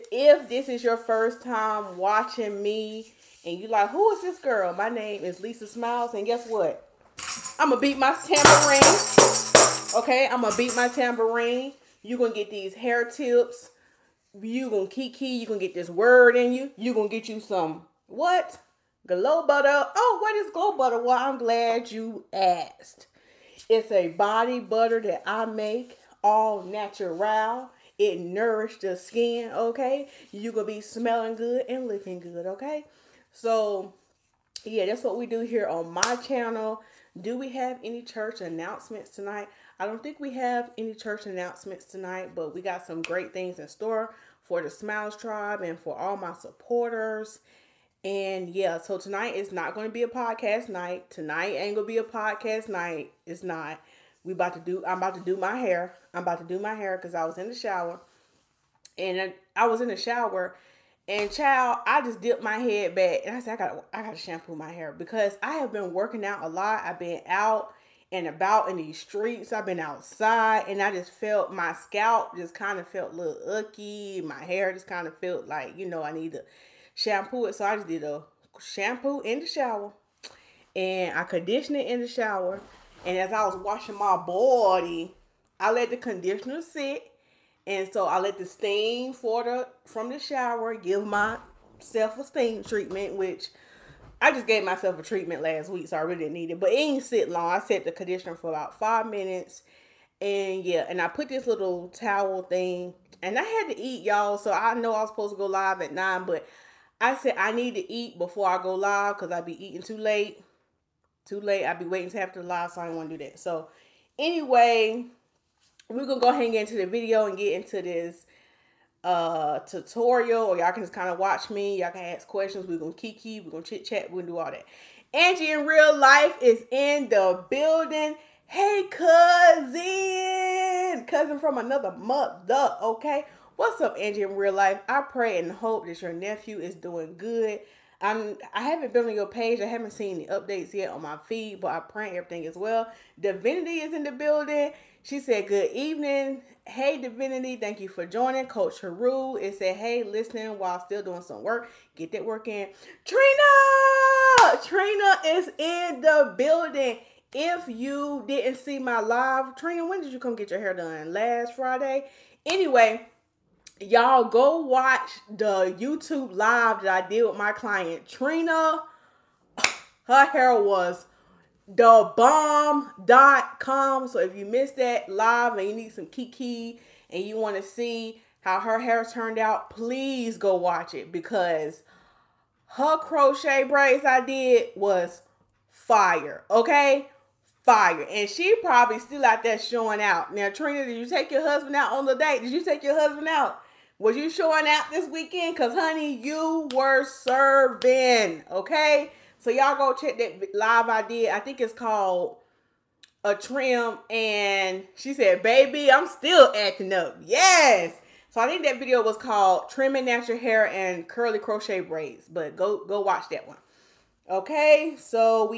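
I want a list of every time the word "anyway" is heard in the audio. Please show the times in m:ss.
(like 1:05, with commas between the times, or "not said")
1:54, 2:42.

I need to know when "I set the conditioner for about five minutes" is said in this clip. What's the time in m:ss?
1:37.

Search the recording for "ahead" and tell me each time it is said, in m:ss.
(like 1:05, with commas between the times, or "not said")
1:56.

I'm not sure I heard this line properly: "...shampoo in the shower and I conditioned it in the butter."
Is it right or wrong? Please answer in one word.
wrong.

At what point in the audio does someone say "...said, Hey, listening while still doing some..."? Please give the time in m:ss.
2:29.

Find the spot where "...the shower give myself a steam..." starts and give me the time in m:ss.
1:30.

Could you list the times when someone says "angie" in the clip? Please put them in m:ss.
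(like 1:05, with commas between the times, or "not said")
2:05, 2:13.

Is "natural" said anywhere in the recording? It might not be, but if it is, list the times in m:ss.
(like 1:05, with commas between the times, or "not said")
0:26, 3:30.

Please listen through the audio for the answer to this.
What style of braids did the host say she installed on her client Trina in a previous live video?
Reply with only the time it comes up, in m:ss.
3:31.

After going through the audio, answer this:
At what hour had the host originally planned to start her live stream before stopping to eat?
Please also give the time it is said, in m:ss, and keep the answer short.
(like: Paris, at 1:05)
9, at 1:45.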